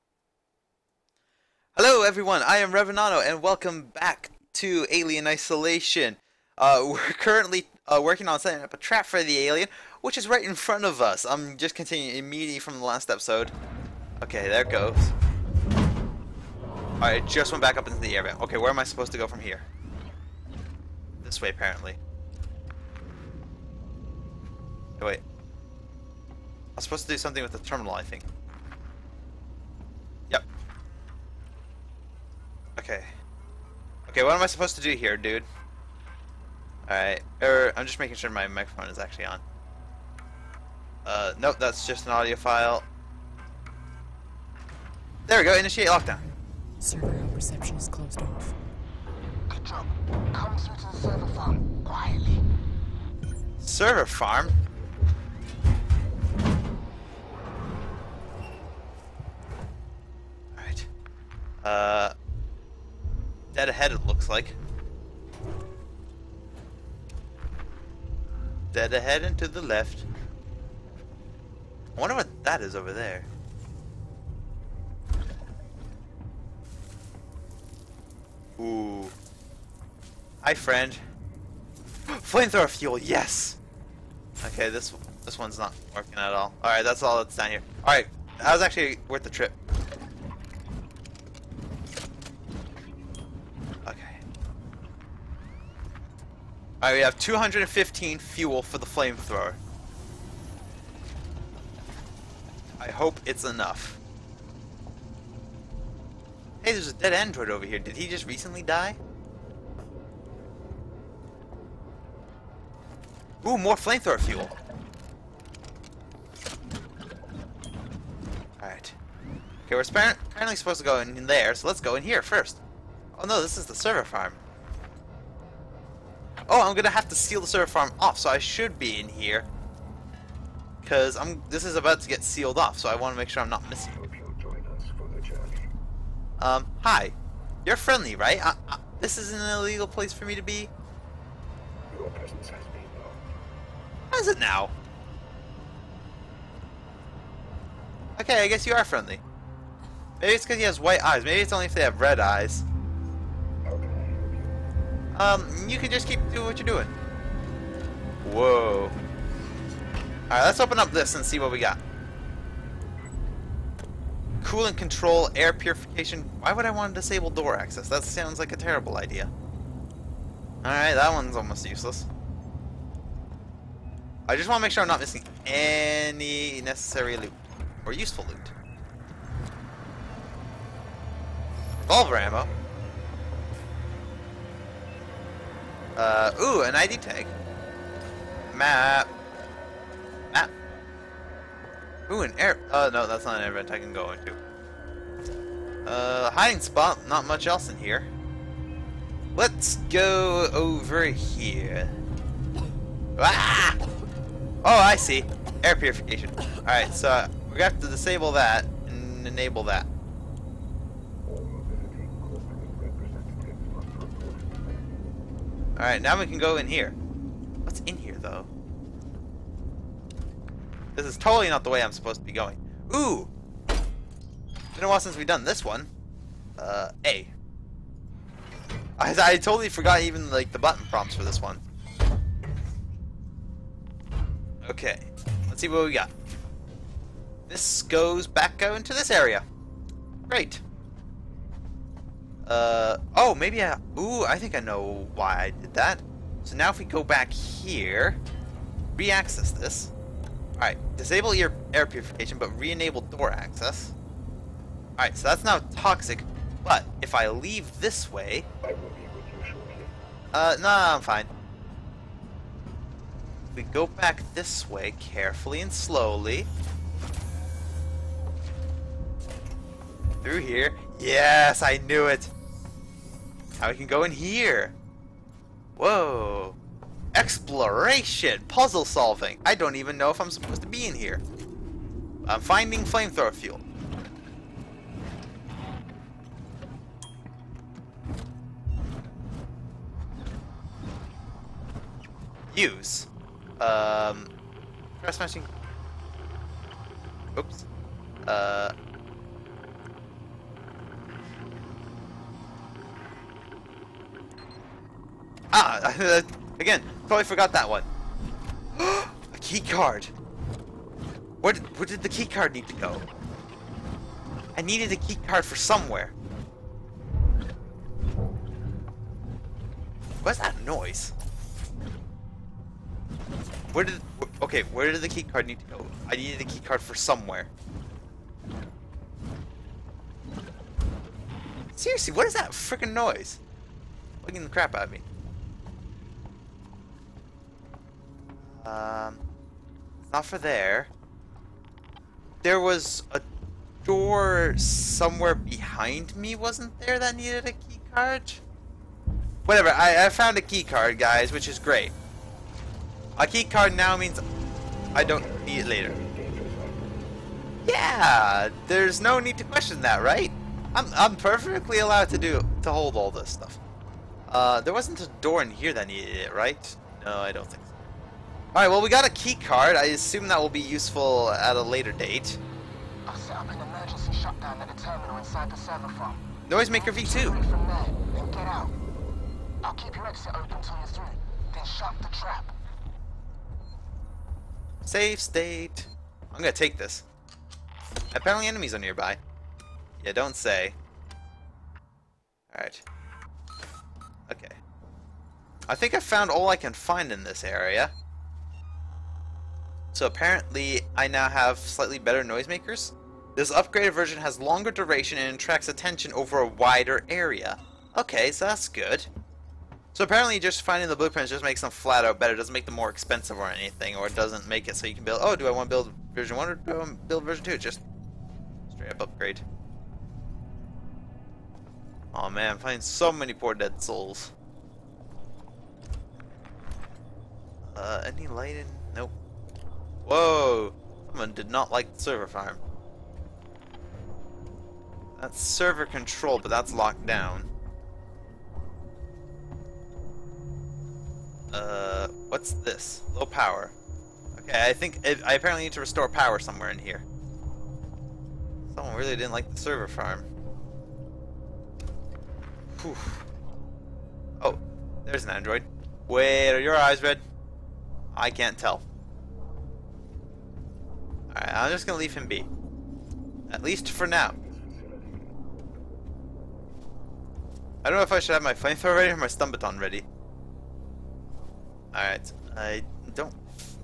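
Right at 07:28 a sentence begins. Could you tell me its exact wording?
Someone really didn't like the server farm.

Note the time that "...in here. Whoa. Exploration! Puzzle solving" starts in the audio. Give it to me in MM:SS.
04:34.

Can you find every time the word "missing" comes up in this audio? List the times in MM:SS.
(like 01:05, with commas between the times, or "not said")
02:13, 02:54.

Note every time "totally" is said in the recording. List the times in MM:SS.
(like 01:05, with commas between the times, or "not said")
03:41, 03:49.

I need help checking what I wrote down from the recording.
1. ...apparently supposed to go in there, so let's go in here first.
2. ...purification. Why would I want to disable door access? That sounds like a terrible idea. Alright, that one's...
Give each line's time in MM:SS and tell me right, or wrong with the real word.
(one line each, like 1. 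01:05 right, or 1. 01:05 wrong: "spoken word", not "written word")
1. 01:59 right
2. 02:45 right.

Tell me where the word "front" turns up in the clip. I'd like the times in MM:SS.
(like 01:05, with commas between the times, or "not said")
00:10.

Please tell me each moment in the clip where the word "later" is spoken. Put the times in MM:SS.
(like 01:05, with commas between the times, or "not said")
05:55, 06:11.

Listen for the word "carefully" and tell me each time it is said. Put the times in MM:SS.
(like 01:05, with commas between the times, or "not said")
04:24.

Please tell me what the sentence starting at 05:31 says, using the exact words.
Seriously, what is that freaking noise?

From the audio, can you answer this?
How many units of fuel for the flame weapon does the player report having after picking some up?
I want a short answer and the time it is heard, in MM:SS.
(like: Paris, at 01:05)
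215, at 01:37.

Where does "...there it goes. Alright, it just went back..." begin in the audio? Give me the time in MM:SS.
00:14.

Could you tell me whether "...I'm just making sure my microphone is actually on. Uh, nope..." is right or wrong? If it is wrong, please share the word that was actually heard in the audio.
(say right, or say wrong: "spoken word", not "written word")
right.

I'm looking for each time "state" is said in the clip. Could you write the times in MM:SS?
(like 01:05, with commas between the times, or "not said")
06:25.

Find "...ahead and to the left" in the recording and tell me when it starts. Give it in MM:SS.
01:08.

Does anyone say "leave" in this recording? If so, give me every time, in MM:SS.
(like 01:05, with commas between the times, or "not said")
04:17, 07:41.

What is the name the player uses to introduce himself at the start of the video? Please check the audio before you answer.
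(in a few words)
Revenano.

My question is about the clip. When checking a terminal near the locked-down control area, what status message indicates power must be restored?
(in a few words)
Low power.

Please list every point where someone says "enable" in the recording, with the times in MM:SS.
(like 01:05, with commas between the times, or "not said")
03:29, 04:12.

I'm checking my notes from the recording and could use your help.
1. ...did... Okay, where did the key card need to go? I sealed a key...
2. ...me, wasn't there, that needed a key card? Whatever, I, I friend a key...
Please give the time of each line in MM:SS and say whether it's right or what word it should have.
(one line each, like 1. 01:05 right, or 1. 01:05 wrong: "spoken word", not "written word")
1. 05:23 wrong: "needed", not "sealed"
2. 05:46 wrong: "found", not "friend".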